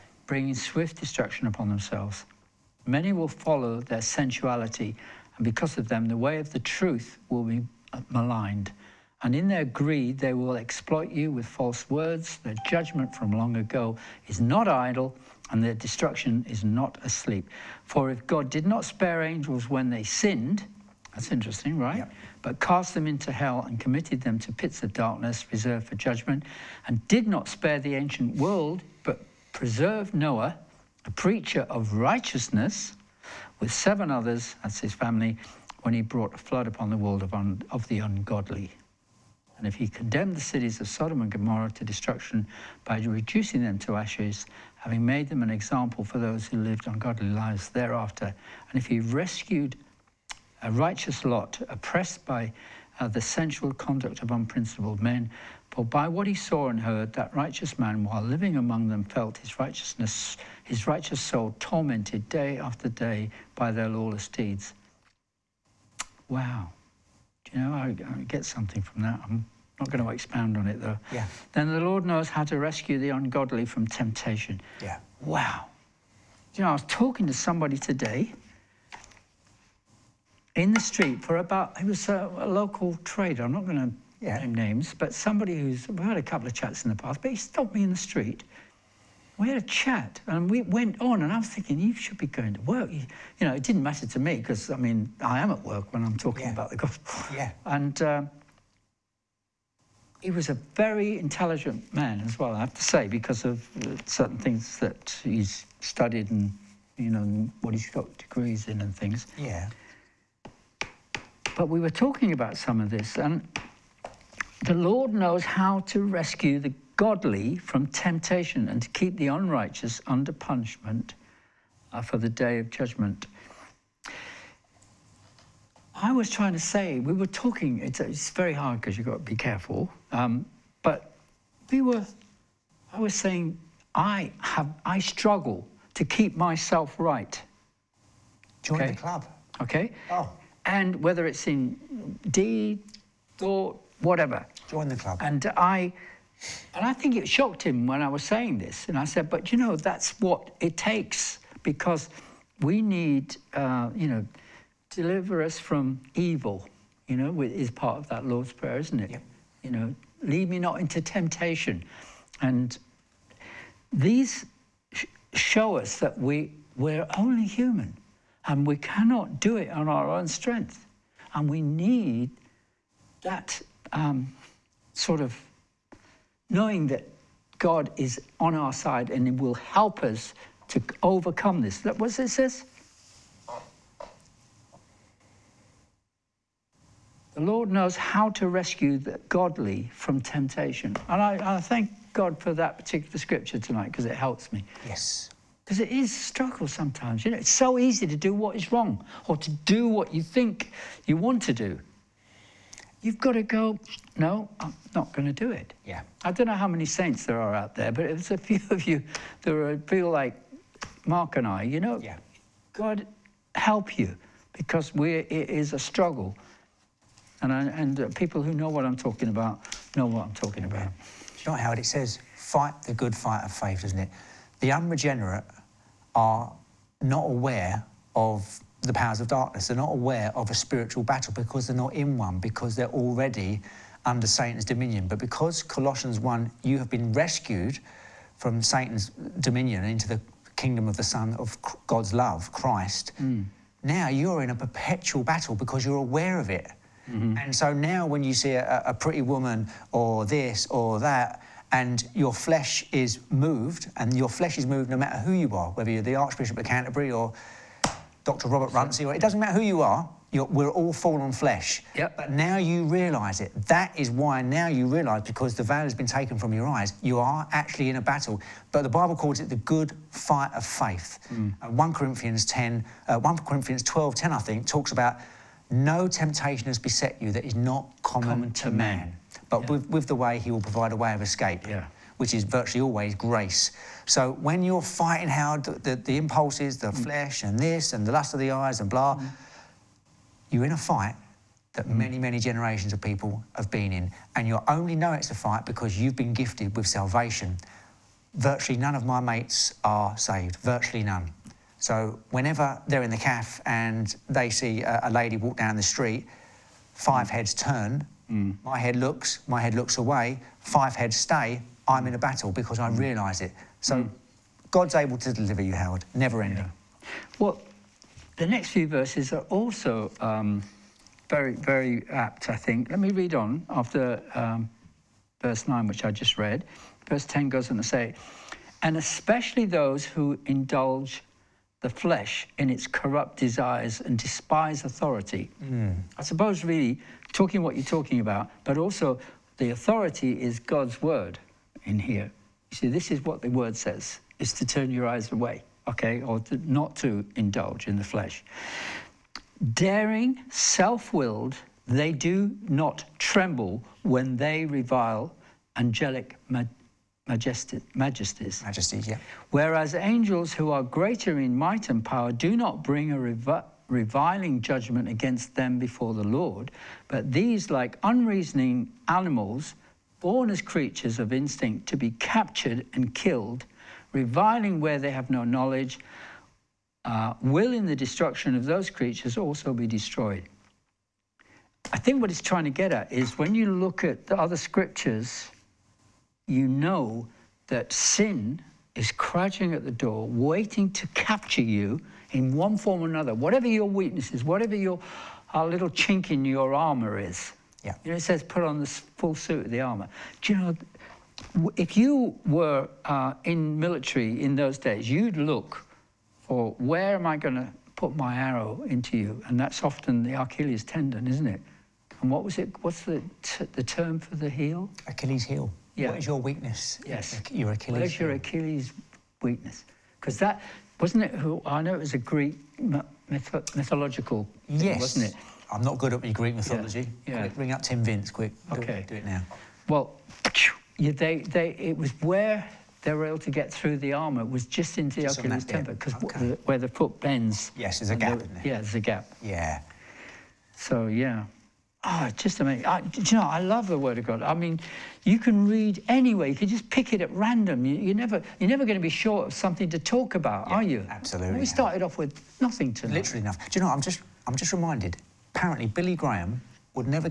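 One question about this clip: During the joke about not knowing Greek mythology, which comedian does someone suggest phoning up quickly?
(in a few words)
Tim Vine.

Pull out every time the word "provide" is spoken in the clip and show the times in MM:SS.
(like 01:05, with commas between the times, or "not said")
04:40.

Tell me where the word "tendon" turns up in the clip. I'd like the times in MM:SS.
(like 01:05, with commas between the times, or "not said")
06:50, 07:15.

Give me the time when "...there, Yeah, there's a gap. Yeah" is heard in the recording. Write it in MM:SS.
07:18.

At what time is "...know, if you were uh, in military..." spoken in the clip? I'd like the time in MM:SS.
06:40.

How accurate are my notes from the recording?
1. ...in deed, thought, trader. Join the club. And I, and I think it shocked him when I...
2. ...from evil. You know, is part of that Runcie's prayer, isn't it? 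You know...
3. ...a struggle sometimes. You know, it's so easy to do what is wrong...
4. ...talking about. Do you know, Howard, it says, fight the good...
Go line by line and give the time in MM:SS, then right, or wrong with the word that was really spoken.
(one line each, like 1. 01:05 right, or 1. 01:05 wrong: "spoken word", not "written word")
1. 02:21 wrong: "whatever", not "trader"
2. 02:35 wrong: "Lord", not "Runcie"
3. 03:16 right
4. 03:40 right.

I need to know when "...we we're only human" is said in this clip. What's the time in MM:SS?
02:46.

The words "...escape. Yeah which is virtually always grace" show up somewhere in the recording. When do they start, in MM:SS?
04:41.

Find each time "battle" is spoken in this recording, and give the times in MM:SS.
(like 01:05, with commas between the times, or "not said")
03:51, 04:05, 04:28, 05:12.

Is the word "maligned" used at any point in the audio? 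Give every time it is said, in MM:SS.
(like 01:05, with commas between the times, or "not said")
00:08.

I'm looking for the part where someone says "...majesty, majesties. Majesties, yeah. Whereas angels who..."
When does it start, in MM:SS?
05:57.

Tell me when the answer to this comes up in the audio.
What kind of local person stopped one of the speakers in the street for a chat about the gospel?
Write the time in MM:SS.
01:22.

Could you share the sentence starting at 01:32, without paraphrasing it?
You, you know, it didn't matter to me because, I mean, I am at work when I'm talking yeah.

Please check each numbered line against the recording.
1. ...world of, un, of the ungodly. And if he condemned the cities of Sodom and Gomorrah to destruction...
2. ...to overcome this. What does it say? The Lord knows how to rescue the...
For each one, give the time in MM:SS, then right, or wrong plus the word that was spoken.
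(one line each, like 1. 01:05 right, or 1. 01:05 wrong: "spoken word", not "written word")
1. 00:36 right
2. 03:00 right.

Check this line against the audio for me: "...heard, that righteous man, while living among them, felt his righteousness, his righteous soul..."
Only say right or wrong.
right.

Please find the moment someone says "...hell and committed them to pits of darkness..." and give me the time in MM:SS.
00:23.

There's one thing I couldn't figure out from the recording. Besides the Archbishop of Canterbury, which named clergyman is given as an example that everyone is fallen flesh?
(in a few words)
Dr. Robert Runcie.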